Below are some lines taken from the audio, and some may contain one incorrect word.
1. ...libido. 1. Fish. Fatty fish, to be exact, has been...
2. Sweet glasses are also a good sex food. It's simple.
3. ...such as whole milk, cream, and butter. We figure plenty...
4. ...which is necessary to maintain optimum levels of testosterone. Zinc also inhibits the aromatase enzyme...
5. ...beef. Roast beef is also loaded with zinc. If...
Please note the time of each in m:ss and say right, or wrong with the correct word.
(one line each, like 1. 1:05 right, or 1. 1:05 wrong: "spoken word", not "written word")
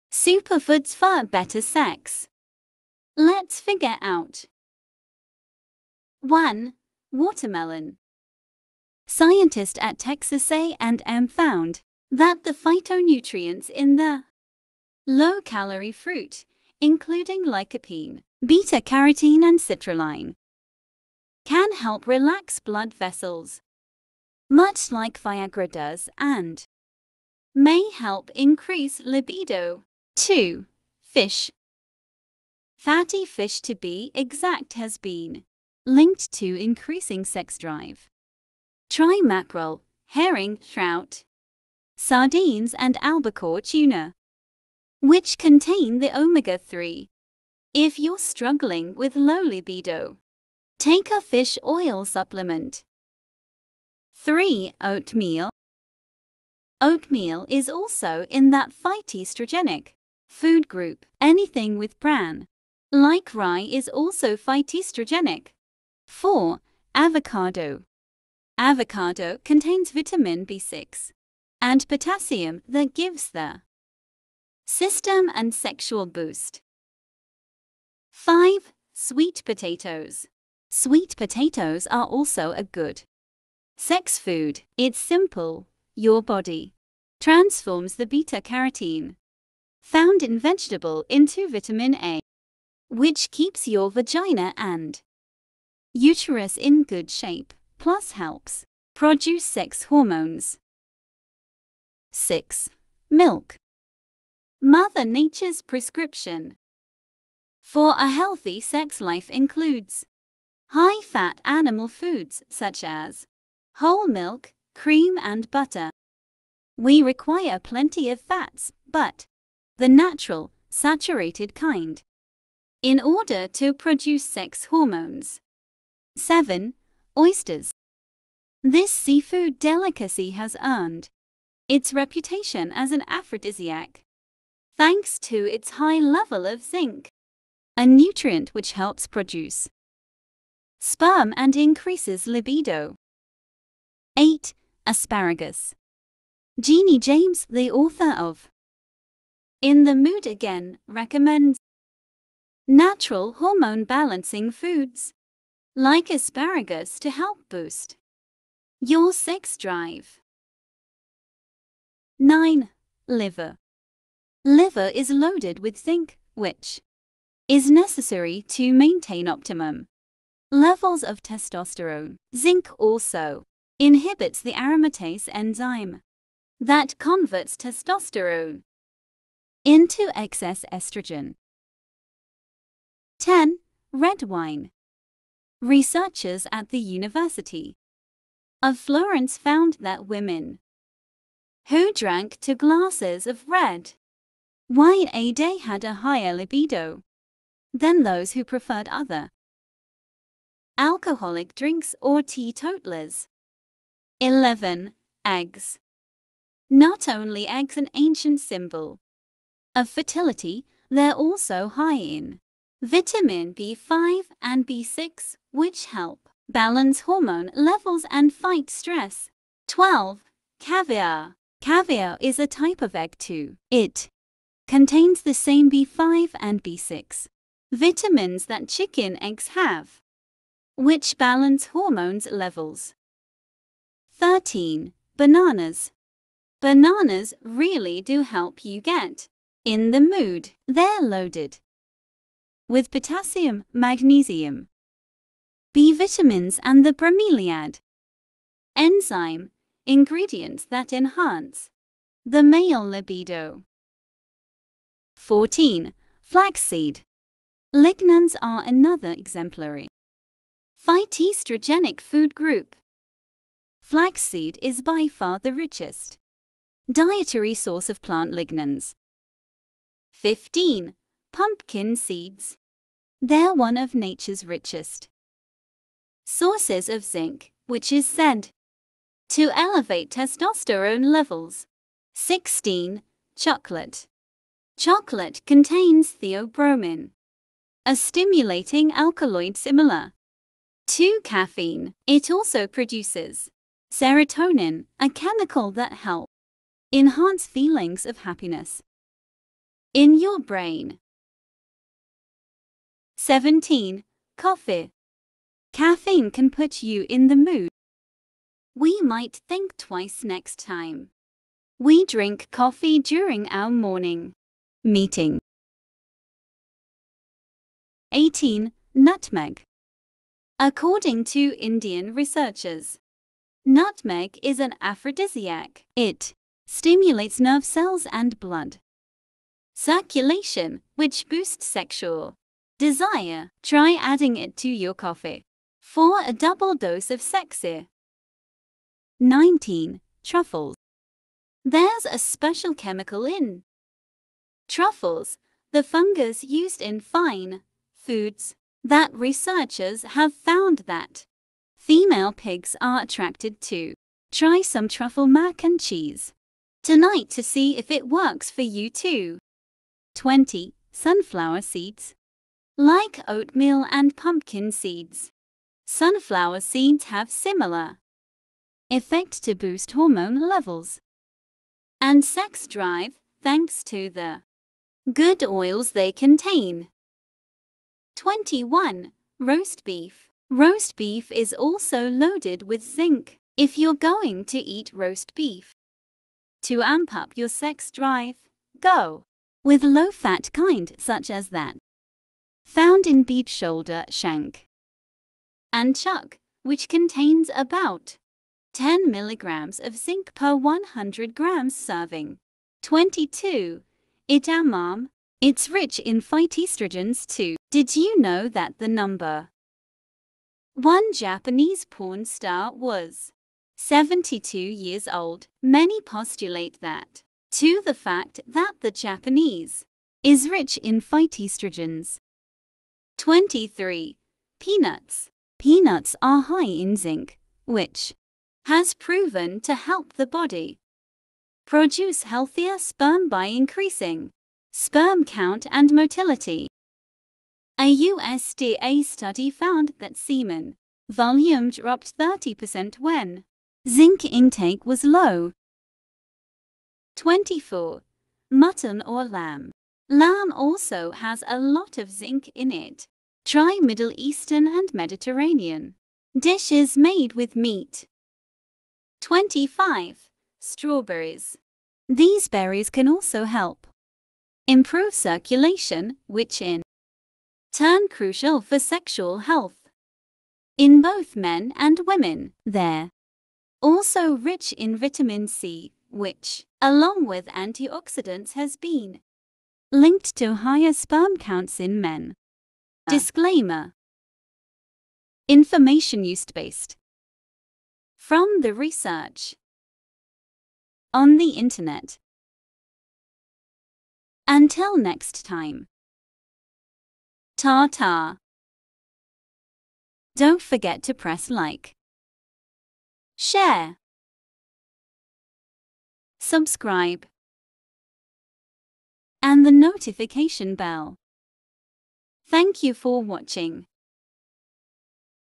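1. 0:29 wrong: "2", not "1"
2. 1:20 wrong: "potatoes", not "glasses"
3. 1:52 wrong: "require", not "figure"
4. 2:46 right
5. 6:19 right.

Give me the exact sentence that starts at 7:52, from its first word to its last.
They're also rich in vitamin C, which along with antioxidants has been linked to higher sperm counts in men.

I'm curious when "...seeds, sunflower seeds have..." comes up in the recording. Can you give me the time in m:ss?
6:04.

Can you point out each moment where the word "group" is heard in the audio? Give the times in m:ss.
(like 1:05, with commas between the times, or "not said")
1:00, 4:22.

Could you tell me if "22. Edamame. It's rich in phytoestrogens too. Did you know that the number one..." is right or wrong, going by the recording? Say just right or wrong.
right.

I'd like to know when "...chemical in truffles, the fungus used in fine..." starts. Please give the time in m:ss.
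5:42.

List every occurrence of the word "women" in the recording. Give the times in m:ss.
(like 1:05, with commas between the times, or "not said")
3:10, 7:52.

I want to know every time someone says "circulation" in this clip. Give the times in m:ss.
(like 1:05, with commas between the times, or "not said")
5:29, 7:45.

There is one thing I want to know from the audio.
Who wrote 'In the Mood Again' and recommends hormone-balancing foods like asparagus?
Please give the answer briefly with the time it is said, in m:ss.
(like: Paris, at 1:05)
Jeannie James, at 2:26.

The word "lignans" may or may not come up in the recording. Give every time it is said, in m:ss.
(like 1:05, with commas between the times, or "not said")
4:17, 4:28.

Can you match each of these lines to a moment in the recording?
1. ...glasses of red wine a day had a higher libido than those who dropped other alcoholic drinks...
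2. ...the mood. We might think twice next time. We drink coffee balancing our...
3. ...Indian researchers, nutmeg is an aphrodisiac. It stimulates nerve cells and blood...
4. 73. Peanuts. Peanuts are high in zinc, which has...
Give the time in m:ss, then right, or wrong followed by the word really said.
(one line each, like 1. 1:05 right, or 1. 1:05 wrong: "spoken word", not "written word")
1. 3:12 wrong: "preferred", not "dropped"
2. 5:07 wrong: "during", not "balancing"
3. 5:21 right
4. 7:03 wrong: "23", not "73".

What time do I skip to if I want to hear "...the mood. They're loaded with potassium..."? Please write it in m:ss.
3:59.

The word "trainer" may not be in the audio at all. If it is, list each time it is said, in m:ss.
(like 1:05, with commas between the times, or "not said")
not said.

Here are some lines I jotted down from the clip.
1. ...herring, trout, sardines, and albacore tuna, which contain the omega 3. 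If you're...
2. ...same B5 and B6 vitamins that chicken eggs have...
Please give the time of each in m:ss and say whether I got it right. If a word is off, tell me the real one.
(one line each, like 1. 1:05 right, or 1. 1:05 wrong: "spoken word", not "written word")
1. 0:40 right
2. 3:45 right.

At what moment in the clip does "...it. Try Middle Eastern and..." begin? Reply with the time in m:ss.
7:32.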